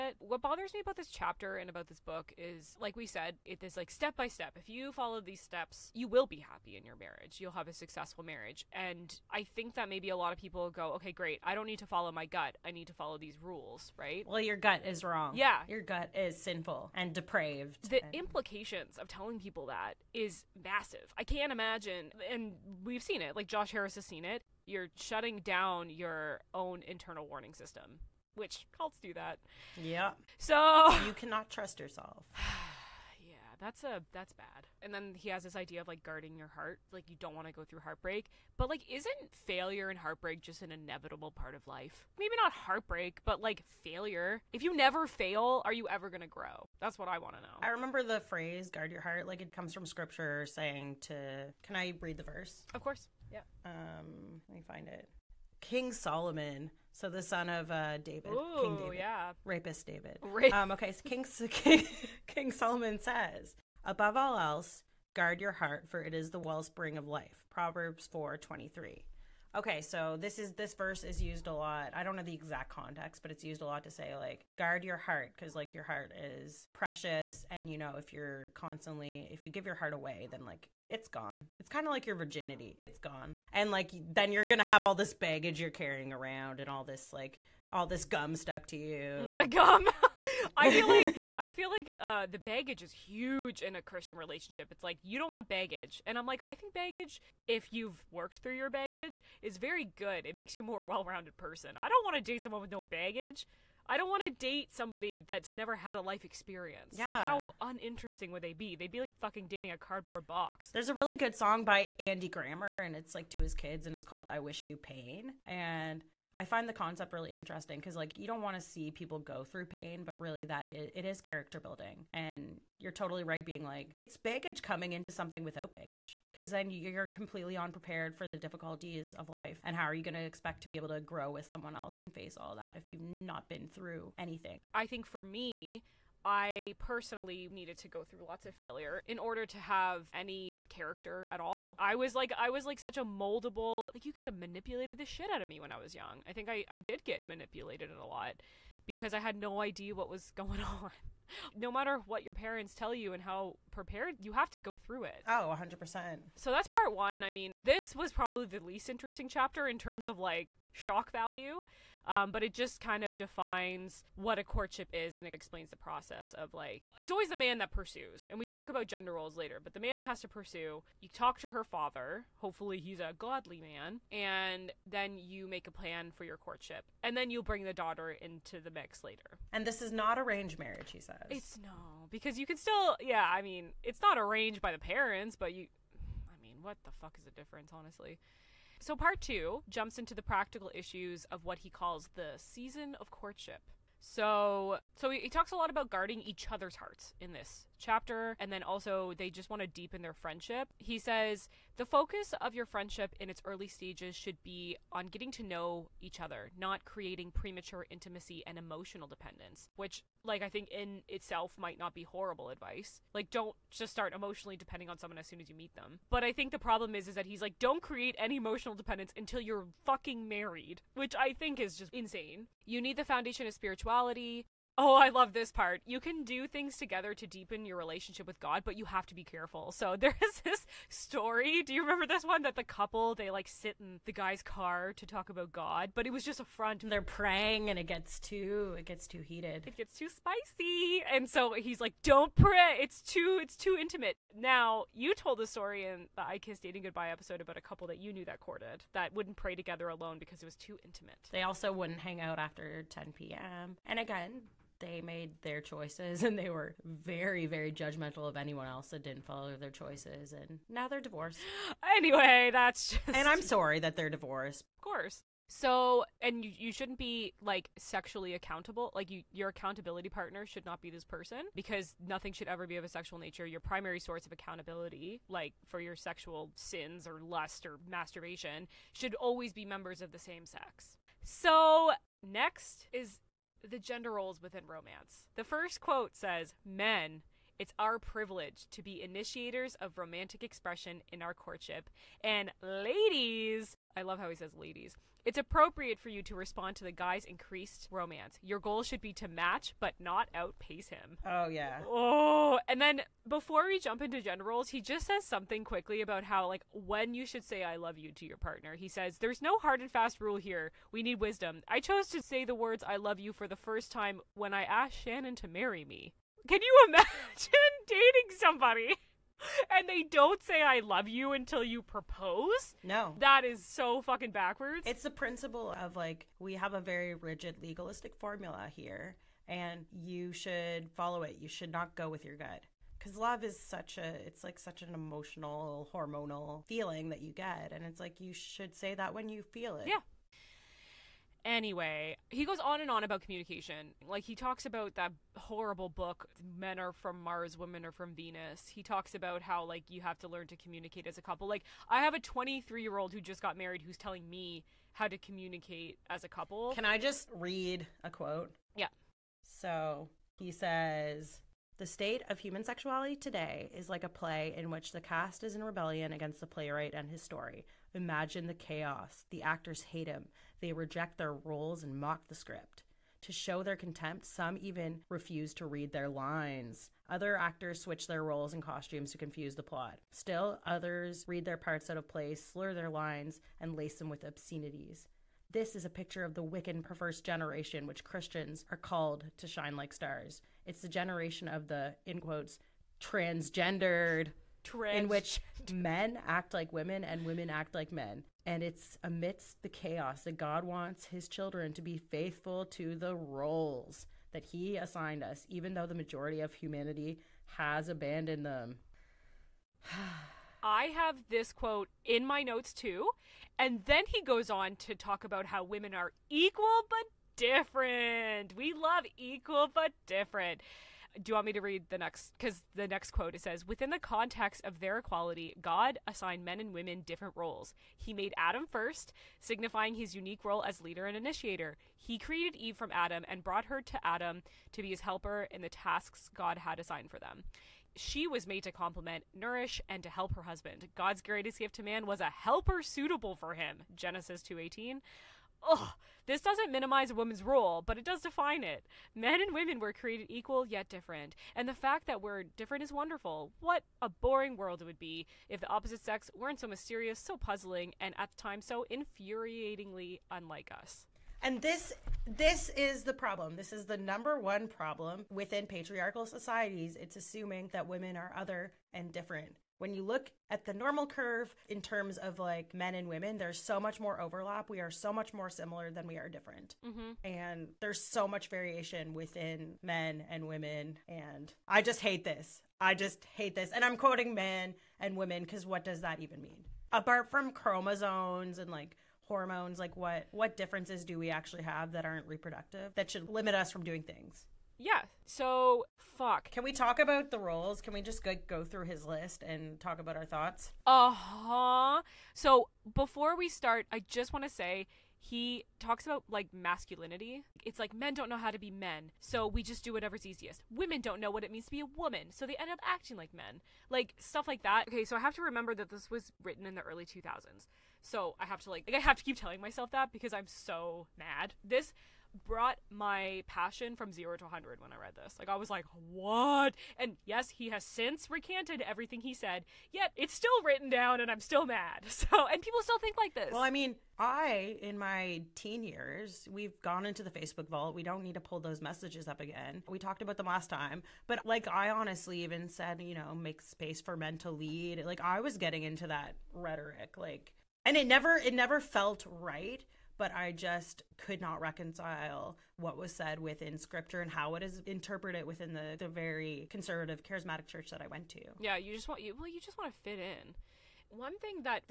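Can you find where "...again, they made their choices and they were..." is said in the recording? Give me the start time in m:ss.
4:13.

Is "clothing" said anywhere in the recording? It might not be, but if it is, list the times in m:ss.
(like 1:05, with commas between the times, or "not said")
not said.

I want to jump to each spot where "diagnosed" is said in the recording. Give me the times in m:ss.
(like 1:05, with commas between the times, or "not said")
not said.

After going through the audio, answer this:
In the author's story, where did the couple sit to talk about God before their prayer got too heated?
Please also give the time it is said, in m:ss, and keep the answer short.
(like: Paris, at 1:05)
The guy's car, at 3:54.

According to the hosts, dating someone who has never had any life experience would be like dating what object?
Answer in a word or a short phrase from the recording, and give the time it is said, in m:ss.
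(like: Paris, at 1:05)
A cardboard box, at 1:49.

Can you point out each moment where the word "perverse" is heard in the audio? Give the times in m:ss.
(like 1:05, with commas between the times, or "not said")
6:26.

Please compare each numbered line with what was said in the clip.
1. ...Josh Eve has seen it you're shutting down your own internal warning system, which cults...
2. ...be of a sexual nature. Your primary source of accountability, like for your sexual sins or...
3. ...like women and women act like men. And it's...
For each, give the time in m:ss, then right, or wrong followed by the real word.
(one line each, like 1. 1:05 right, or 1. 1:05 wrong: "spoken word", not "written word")
1. 0:23 wrong: "Harris", not "Eve"
2. 4:32 right
3. 6:36 right.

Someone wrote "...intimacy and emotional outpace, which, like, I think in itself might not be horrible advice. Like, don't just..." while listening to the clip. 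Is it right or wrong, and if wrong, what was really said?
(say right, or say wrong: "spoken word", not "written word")
wrong: "dependence", not "outpace".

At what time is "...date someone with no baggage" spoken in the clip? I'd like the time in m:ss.
1:42.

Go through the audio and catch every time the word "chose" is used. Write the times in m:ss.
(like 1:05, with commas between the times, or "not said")
5:11.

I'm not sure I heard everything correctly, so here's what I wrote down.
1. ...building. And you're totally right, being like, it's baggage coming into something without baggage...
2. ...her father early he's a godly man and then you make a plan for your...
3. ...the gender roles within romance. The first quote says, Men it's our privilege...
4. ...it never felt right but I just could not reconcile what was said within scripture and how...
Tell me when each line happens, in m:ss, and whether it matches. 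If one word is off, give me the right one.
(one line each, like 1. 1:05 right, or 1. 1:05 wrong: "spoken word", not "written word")
1. 2:01 right
2. 2:51 wrong: "hopefully", not "early"
3. 4:43 right
4. 9:08 right.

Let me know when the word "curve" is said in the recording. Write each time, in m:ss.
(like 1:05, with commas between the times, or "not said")
7:51.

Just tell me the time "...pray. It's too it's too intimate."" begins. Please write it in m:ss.
4:02.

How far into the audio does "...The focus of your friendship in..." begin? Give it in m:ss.
3:21.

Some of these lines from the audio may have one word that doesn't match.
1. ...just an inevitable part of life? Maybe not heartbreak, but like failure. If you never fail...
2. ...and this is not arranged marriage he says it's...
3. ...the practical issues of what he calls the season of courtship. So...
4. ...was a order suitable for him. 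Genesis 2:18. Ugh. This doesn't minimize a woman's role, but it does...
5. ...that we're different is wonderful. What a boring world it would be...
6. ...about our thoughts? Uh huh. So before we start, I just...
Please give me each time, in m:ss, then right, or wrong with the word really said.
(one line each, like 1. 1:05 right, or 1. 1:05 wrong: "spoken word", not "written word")
1. 0:40 right
2. 2:59 right
3. 3:10 right
4. 7:22 wrong: "helper", not "order"
5. 7:32 right
6. 8:19 right.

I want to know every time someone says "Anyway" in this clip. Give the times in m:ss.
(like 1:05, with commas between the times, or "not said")
4:21, 5:41.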